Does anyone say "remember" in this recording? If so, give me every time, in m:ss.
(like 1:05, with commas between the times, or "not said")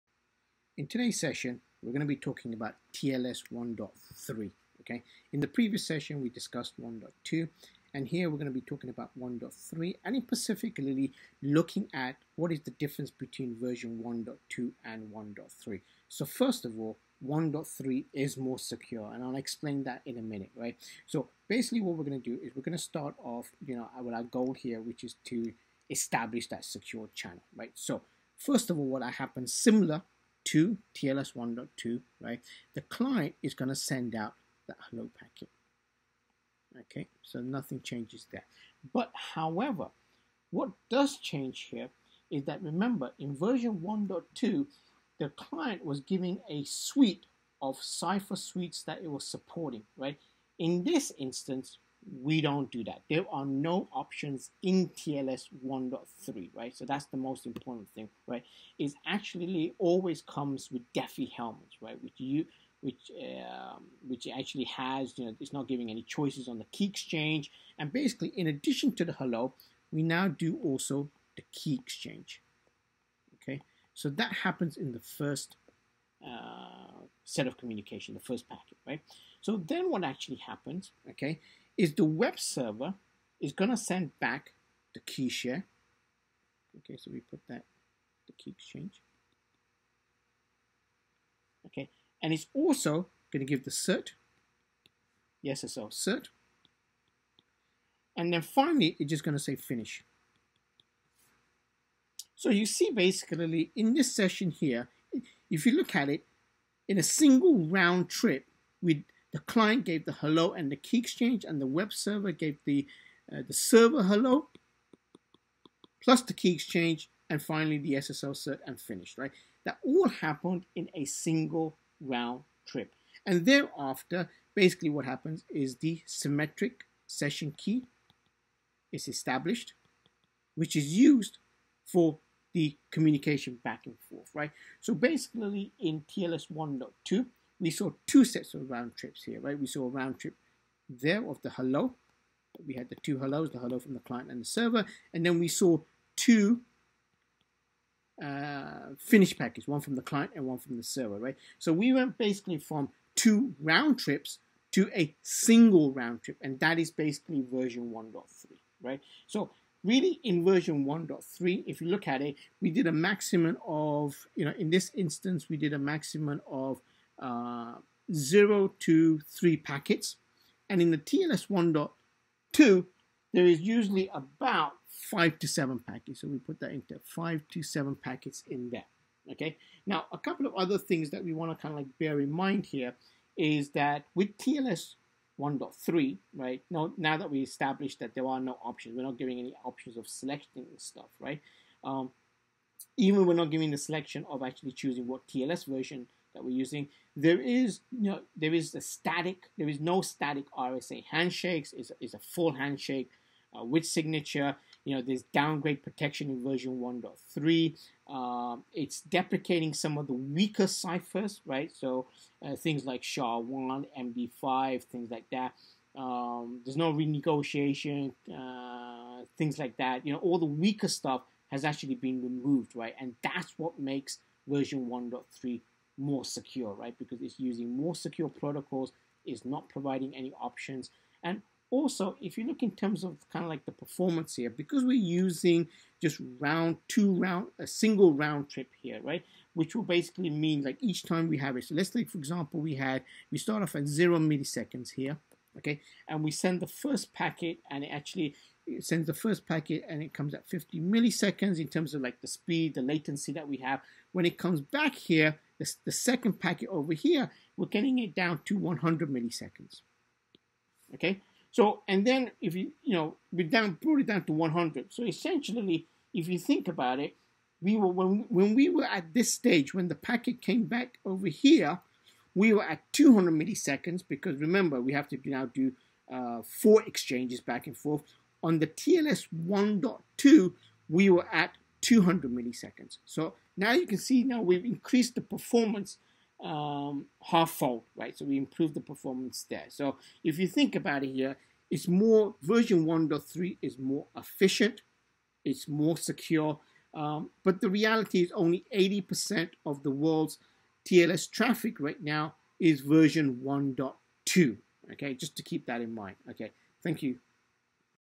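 0:42, 4:34.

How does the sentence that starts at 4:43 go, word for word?
So now you can see now we've increased the performance um, half fold, right?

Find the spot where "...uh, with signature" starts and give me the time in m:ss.
3:23.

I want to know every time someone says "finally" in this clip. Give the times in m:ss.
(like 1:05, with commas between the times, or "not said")
1:38, 1:57.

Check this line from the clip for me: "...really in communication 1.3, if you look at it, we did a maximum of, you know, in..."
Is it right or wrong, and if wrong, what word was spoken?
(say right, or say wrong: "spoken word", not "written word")
wrong: "version", not "communication".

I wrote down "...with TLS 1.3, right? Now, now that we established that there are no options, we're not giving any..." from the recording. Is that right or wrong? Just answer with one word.
right.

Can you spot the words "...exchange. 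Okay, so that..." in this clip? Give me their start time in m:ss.
1:11.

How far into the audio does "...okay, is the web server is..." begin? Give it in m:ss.
1:21.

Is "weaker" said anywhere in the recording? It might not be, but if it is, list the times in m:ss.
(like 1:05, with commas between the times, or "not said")
3:30, 3:40.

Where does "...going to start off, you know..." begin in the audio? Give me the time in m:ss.
0:22.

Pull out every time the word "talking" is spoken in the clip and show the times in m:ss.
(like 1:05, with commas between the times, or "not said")
0:02, 0:08.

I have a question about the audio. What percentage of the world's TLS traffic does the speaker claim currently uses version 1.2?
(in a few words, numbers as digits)
80%.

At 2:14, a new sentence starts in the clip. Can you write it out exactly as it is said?
So basically in TLS 1.2, we saw two sets of round trips here, right?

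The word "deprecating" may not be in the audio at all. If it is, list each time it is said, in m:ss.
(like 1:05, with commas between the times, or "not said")
3:29.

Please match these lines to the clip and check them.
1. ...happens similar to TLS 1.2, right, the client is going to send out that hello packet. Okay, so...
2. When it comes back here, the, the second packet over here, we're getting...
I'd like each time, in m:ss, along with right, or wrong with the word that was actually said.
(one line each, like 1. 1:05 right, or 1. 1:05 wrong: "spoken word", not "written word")
1. 0:29 right
2. 4:14 right.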